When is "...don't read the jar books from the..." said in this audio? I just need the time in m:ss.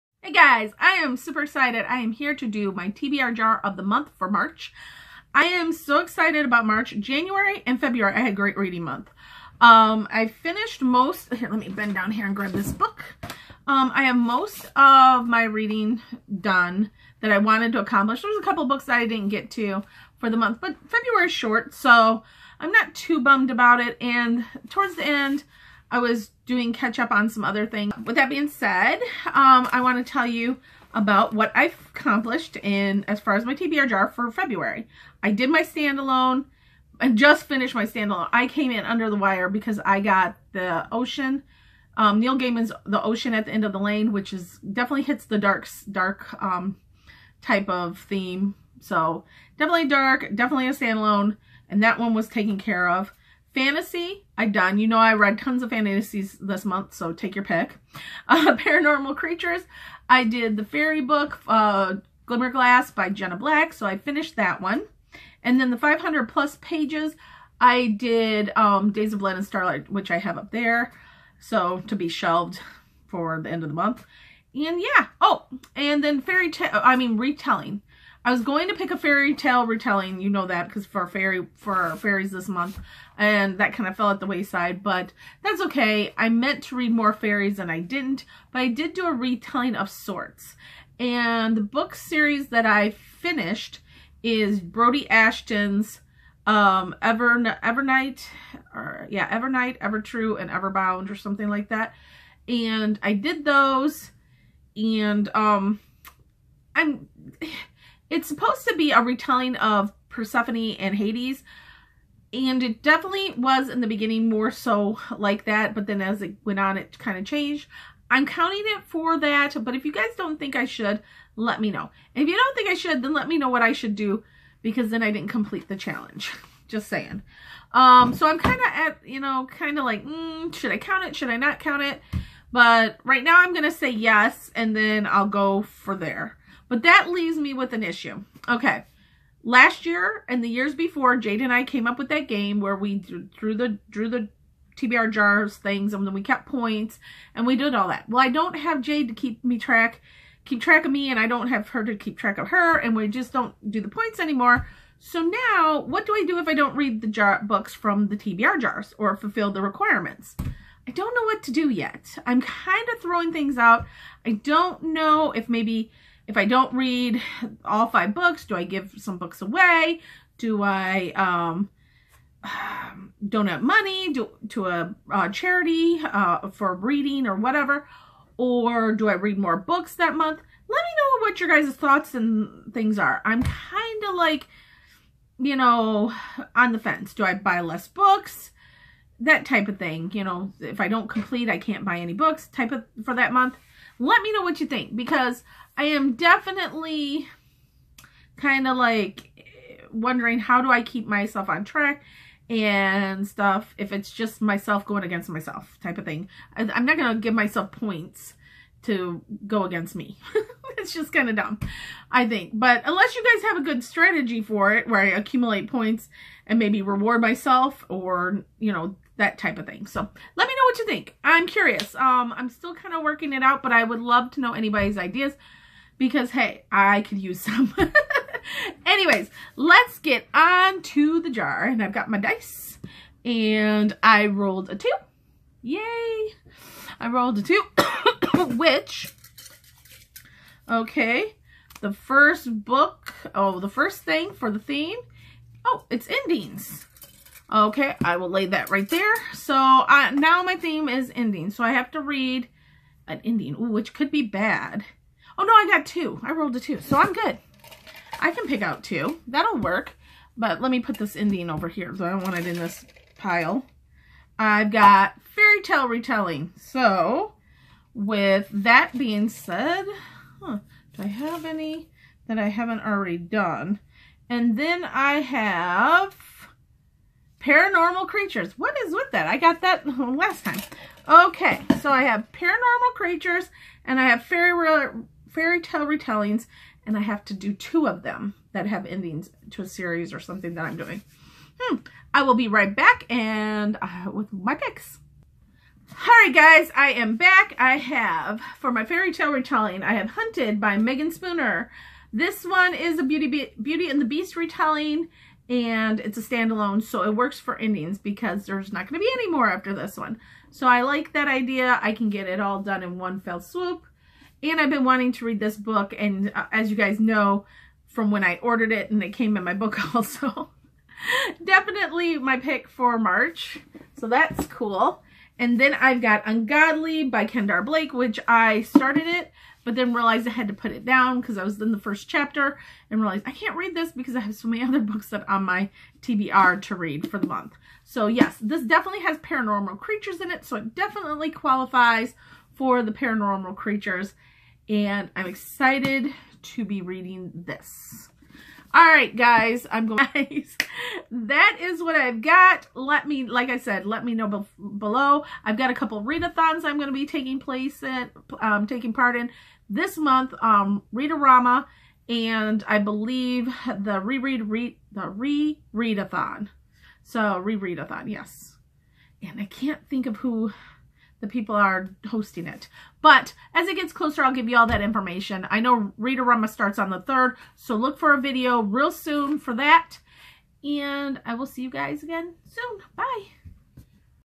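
2:36.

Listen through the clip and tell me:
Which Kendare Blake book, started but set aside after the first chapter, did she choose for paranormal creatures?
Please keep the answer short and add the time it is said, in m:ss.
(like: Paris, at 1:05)
Ungodly, at 5:26.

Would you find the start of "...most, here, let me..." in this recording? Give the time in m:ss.
0:10.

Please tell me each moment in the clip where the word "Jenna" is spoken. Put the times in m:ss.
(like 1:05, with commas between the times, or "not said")
1:03.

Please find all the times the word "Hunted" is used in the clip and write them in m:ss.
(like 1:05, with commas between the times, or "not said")
5:00.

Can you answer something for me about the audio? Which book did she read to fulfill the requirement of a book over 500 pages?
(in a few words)
Days of Blood and Starlight.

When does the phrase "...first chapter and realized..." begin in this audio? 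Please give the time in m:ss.
5:31.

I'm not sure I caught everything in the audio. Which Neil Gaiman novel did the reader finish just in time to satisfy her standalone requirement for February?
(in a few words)
The Ocean at the End of the Lane.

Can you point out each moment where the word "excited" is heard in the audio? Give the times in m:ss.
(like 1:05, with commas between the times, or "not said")
0:01, 0:05, 5:45.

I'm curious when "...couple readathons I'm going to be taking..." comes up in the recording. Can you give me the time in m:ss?
5:55.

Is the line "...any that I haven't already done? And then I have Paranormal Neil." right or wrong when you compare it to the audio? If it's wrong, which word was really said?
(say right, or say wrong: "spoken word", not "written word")
wrong: "Creatures", not "Neil".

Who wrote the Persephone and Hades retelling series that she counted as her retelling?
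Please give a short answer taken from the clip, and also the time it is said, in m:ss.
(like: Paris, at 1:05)
Brodi Ashton, at 1:34.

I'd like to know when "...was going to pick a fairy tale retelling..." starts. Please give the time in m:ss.
1:18.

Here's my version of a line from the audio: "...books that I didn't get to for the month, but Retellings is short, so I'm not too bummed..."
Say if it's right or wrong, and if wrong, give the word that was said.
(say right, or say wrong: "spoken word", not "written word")
wrong: "February", not "Retellings".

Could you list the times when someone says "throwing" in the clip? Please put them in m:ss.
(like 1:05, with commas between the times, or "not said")
2:43.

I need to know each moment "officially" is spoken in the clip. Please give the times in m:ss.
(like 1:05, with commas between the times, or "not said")
not said.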